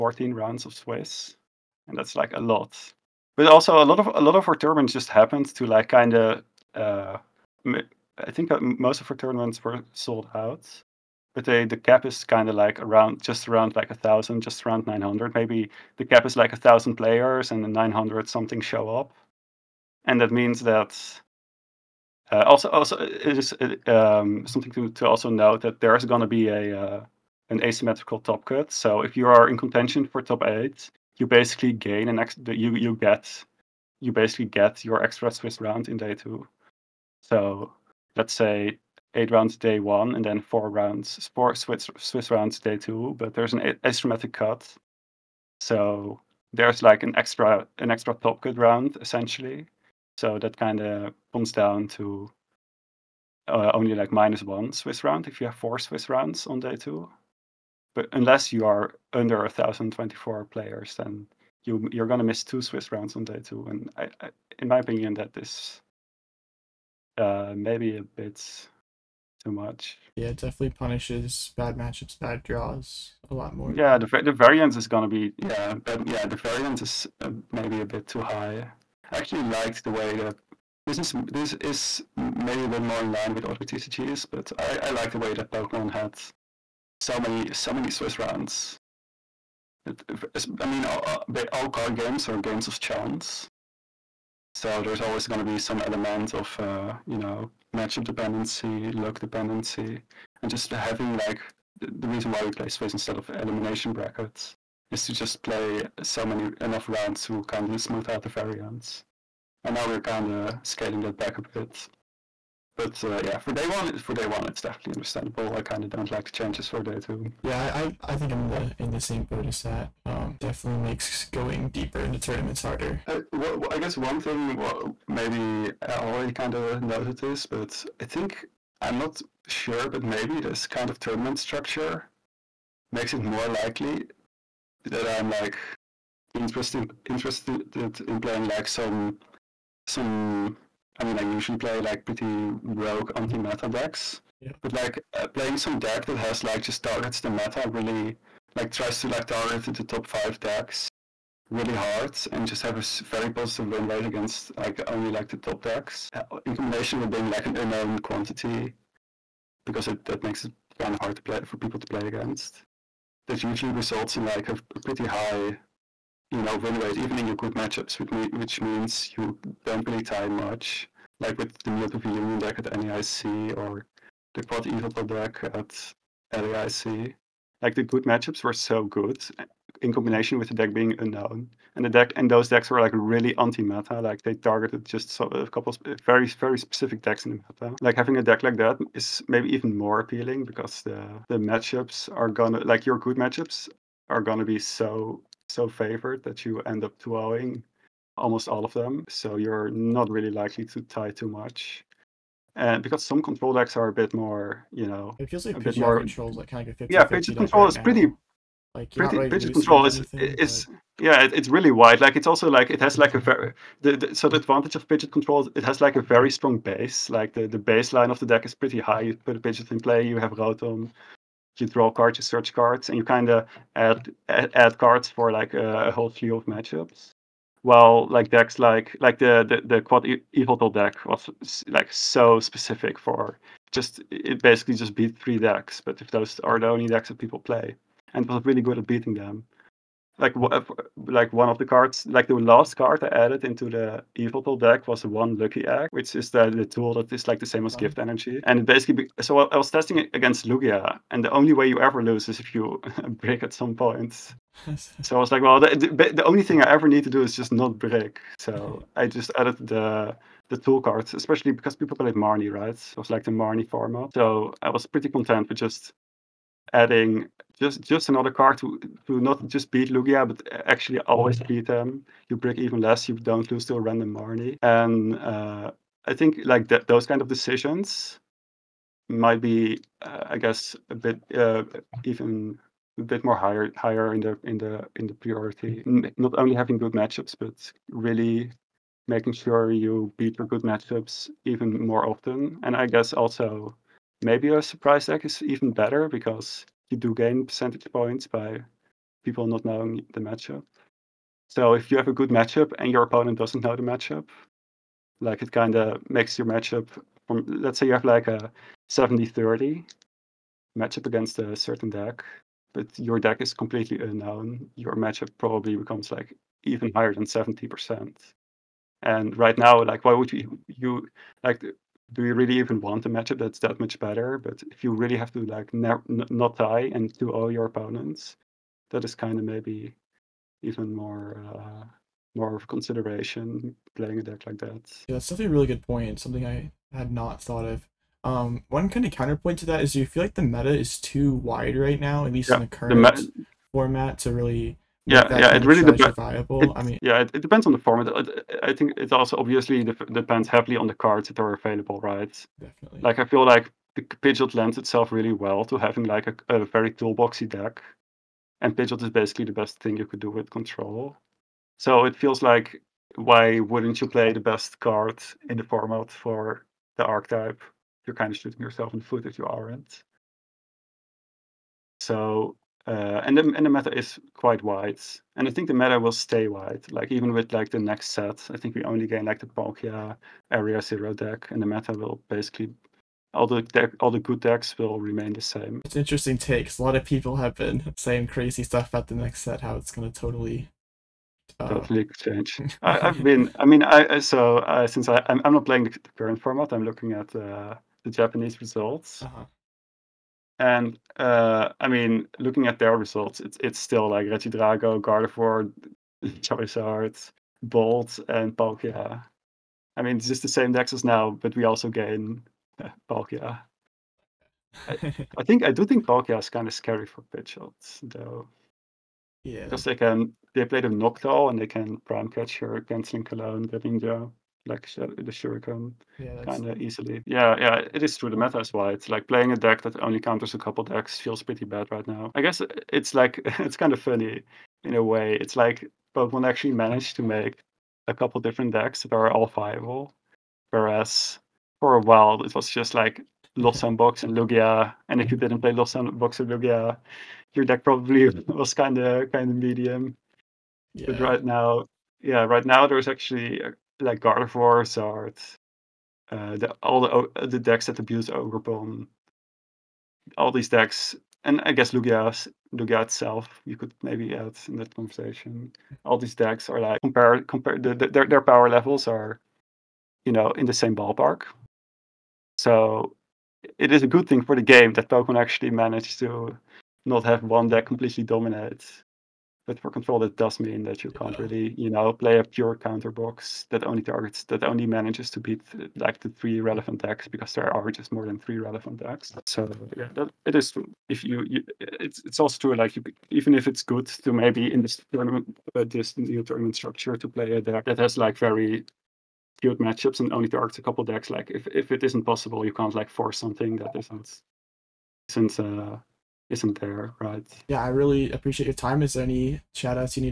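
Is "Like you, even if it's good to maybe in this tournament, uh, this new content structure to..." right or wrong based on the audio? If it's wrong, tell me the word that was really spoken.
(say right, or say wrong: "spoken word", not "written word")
wrong: "tournament", not "content".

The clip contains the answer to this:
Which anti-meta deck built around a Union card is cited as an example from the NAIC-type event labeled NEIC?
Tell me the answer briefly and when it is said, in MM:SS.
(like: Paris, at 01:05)
Mewtwo V Union, at 02:51.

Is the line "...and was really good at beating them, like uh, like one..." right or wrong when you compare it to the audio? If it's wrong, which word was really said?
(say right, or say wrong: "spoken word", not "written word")
right.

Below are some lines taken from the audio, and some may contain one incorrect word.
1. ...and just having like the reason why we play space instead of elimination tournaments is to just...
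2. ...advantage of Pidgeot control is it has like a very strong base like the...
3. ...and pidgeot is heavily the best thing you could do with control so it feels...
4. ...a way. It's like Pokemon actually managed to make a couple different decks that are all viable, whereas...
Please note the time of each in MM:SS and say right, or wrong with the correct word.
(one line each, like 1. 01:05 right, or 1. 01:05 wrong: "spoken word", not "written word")
1. 01:40 wrong: "brackets", not "tournaments"
2. 03:34 right
3. 05:58 wrong: "basically", not "heavily"
4. 07:14 right.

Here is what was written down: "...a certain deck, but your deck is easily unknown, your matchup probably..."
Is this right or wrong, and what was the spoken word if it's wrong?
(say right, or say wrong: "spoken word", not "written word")
wrong: "completely", not "easily".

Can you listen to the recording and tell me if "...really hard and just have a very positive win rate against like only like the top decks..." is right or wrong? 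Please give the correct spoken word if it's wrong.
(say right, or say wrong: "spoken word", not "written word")
right.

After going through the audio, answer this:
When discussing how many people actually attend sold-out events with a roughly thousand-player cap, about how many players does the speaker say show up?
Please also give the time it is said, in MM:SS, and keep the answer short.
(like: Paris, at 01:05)
900, at 00:14.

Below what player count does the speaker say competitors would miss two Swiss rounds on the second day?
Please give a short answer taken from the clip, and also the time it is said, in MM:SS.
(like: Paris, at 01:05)
1024, at 00:59.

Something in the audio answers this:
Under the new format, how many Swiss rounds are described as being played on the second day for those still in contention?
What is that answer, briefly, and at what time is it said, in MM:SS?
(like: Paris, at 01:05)
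4, at 00:41.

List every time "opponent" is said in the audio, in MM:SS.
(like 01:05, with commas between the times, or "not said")
05:03, 05:27.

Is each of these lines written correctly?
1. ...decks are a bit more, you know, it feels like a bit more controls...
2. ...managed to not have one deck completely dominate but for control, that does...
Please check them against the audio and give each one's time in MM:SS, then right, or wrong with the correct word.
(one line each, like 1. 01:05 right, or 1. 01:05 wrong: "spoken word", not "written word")
1. 03:23 right
2. 07:55 right.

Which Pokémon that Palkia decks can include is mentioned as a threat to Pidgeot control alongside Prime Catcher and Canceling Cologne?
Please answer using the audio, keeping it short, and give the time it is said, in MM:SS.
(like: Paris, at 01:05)
Noctowl, at 07:00.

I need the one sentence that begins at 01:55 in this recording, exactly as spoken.
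I kind of don't like the changes for day two.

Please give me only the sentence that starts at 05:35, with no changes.
Yeah, that's definitely a really good point.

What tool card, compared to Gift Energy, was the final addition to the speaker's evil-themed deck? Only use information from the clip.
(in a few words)
Lucky Egg.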